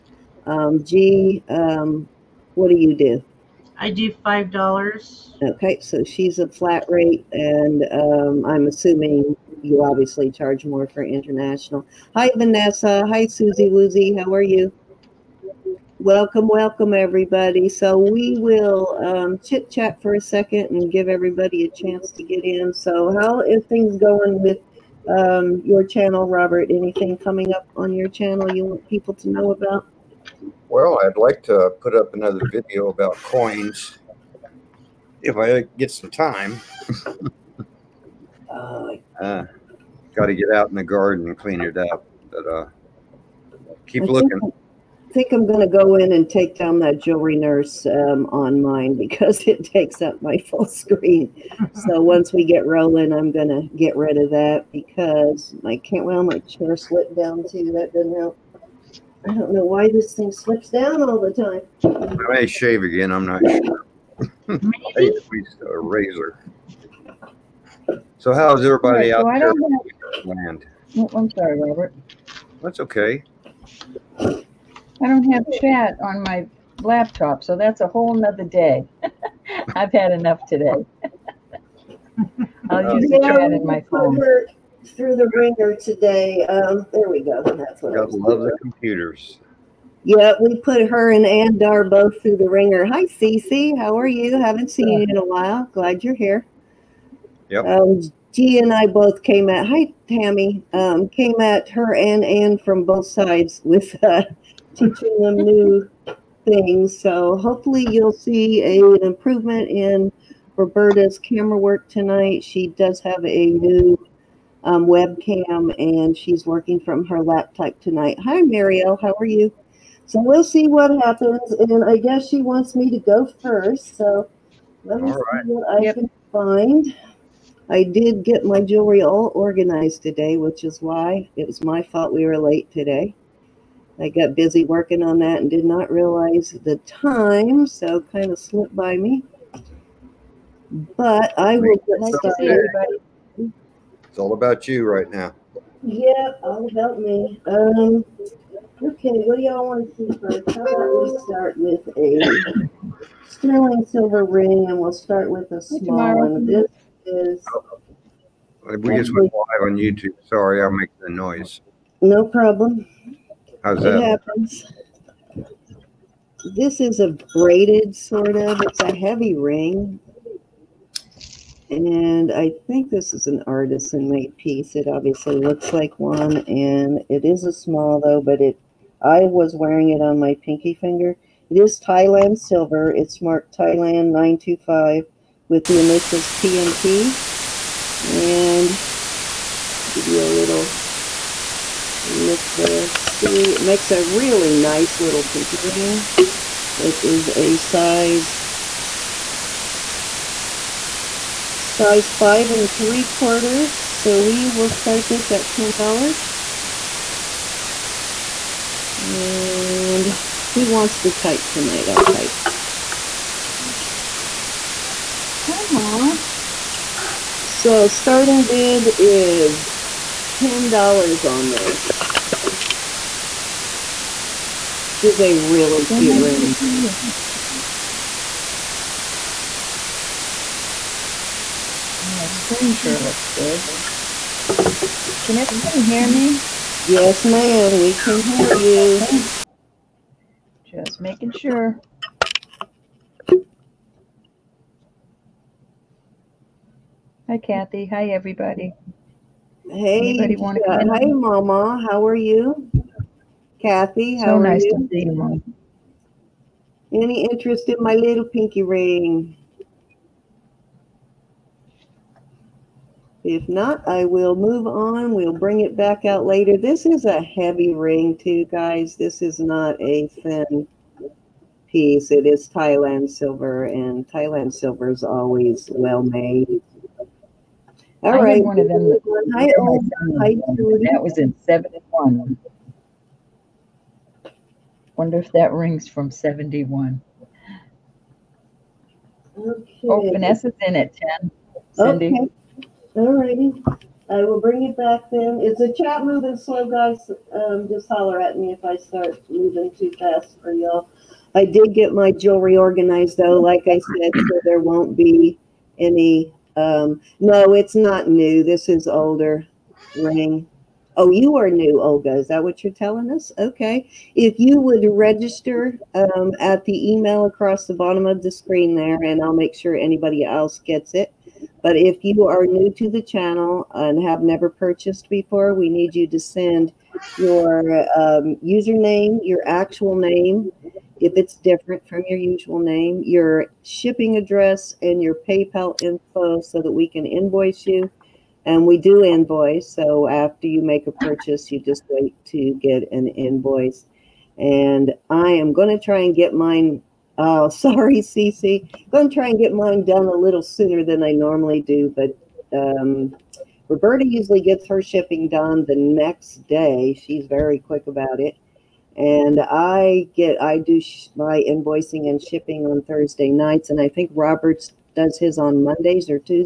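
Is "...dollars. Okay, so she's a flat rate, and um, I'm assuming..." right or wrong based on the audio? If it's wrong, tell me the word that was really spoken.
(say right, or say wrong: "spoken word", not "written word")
right.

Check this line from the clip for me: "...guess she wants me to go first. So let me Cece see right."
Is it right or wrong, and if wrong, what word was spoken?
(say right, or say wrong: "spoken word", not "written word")
wrong: "All", not "Cece".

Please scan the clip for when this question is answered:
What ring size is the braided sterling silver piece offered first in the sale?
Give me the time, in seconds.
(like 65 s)
202 s.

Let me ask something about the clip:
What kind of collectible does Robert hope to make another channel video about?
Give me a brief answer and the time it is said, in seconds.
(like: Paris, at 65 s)
coins, at 33 s.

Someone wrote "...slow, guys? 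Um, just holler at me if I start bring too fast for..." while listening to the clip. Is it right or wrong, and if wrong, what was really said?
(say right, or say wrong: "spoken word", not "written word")
wrong: "moving", not "bring".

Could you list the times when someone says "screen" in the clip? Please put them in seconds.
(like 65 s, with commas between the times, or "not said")
50 s, 232 s, 318 s.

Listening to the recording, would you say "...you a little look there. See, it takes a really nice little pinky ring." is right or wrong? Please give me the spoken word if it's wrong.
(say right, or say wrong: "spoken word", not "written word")
wrong: "makes", not "takes".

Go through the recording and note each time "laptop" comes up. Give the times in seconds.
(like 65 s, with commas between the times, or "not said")
76 s, 117 s.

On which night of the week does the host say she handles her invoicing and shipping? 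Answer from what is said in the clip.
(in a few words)
Thursday.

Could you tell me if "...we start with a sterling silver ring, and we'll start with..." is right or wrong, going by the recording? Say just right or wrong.
right.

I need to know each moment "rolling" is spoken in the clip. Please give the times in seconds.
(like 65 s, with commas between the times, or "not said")
52 s.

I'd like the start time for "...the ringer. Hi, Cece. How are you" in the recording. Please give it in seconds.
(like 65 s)
92 s.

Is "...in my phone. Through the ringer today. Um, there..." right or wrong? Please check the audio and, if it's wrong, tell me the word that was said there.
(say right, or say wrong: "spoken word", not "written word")
right.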